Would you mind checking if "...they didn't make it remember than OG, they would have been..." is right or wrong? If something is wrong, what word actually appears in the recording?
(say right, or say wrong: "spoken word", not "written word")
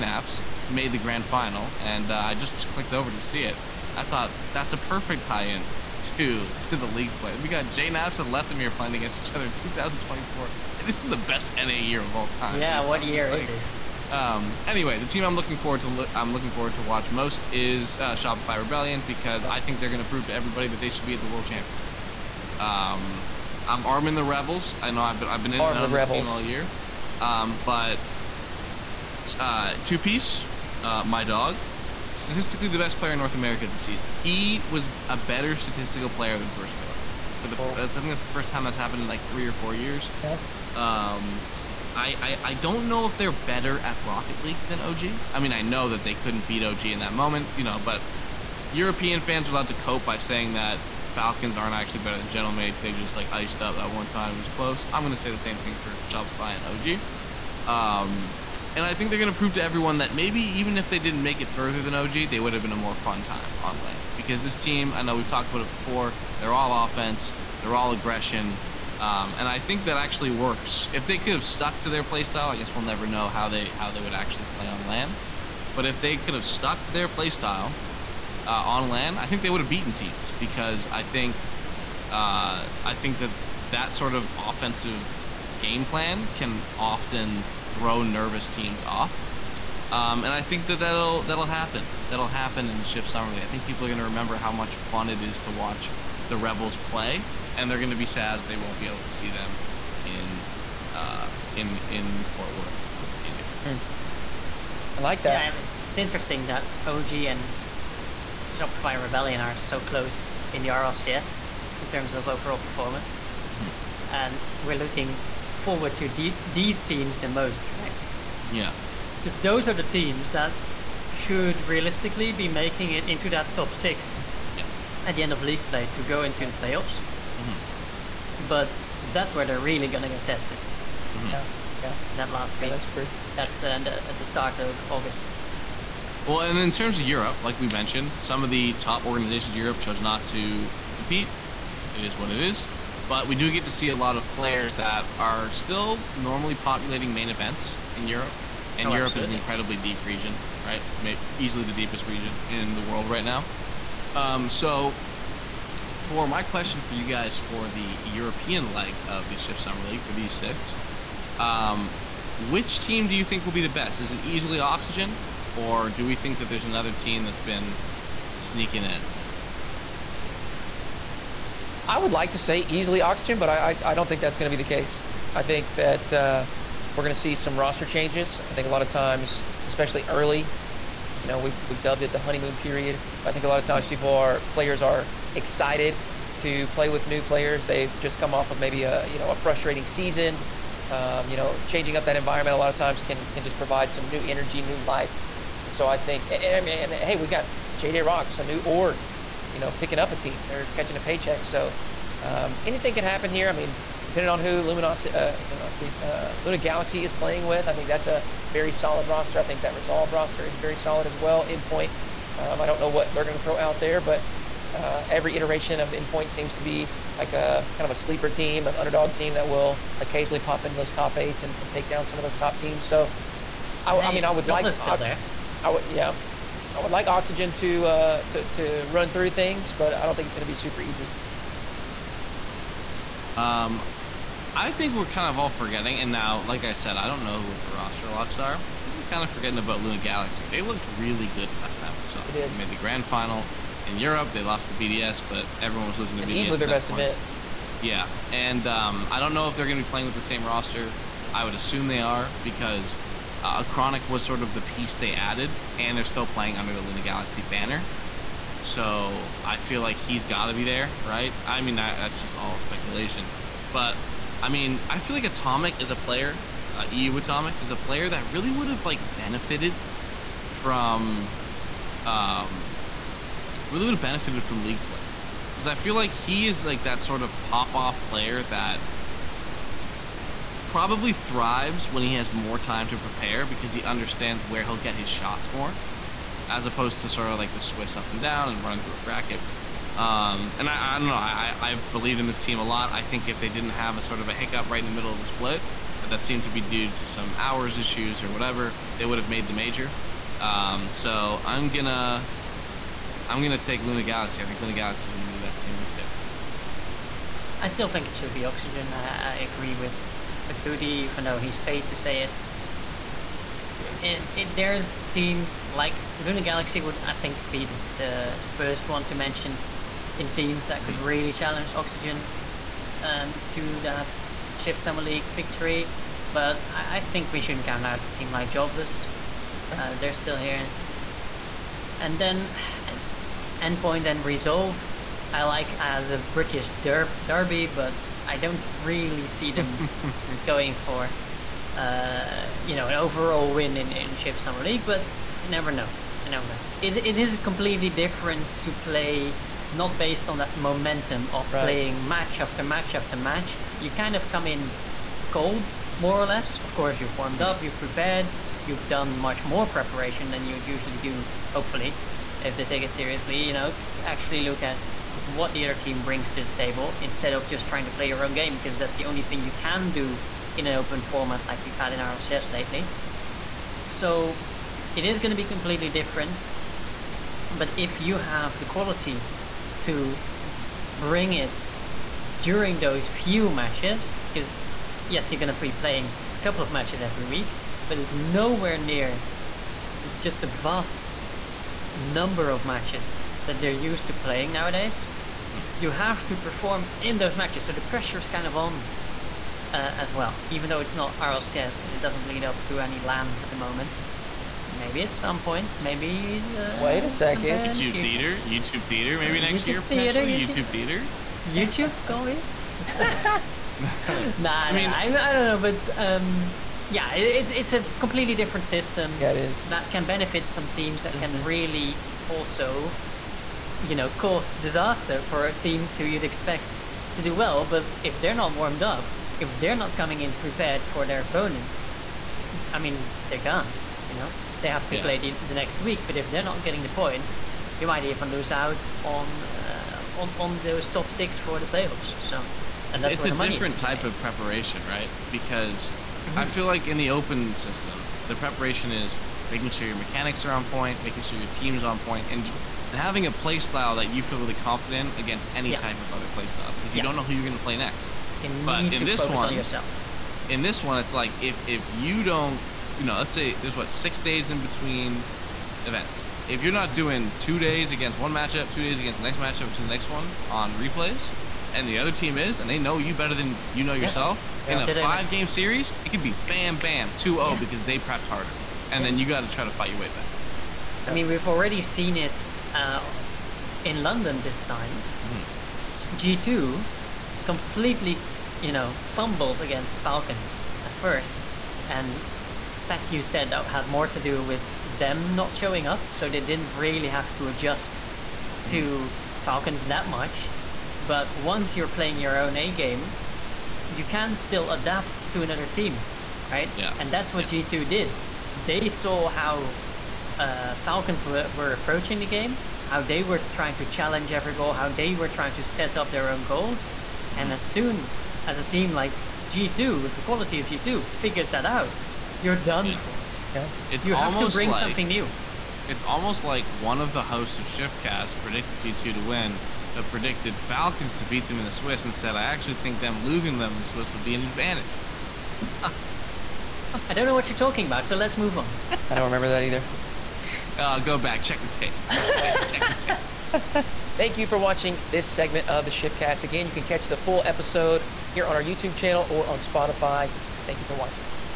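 wrong: "further", not "remember".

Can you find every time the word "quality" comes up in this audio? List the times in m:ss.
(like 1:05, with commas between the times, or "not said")
6:18, 8:40.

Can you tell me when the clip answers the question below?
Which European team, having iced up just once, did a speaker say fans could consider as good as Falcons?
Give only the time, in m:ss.
0:52.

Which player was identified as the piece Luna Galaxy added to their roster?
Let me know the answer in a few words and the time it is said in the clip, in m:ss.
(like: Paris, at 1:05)
Chronic, at 4:13.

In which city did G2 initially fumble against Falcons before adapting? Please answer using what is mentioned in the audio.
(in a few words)
London.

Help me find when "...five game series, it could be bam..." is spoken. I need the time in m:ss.
7:54.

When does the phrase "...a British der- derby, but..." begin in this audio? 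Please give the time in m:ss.
5:36.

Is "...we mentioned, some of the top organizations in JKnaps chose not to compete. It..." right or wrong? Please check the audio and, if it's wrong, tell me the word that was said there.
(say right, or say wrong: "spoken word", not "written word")
wrong: "Europe", not "JKnaps".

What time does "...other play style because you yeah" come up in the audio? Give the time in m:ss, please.
7:36.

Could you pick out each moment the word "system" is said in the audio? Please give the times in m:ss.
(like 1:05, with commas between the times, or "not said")
6:58, 7:27.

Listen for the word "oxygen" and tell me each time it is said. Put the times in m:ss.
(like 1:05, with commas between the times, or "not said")
2:44, 2:53, 3:47, 5:08, 5:21.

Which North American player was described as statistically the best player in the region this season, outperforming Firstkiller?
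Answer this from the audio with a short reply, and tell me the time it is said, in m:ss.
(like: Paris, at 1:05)
Two piece, at 0:29.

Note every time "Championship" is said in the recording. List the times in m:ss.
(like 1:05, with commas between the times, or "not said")
0:21.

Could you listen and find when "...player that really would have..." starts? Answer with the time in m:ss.
4:27.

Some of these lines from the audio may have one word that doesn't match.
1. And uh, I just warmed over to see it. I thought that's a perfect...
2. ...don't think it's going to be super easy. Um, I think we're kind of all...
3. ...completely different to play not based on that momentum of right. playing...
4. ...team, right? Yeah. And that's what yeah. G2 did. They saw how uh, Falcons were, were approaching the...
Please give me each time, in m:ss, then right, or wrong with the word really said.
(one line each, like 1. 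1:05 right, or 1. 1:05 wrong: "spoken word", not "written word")
1. 0:01 wrong: "clicked", not "warmed"
2. 3:50 right
3. 5:47 right
4. 8:25 right.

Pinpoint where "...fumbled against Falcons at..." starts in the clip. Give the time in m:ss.
8:09.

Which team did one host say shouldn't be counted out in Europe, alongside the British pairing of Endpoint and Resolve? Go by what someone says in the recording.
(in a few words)
Jobless.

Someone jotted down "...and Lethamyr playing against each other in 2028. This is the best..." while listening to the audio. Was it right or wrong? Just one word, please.
wrong.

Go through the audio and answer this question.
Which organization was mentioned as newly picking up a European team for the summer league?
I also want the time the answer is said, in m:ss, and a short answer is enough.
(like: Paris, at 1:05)
JJ Rocks, at 3:17.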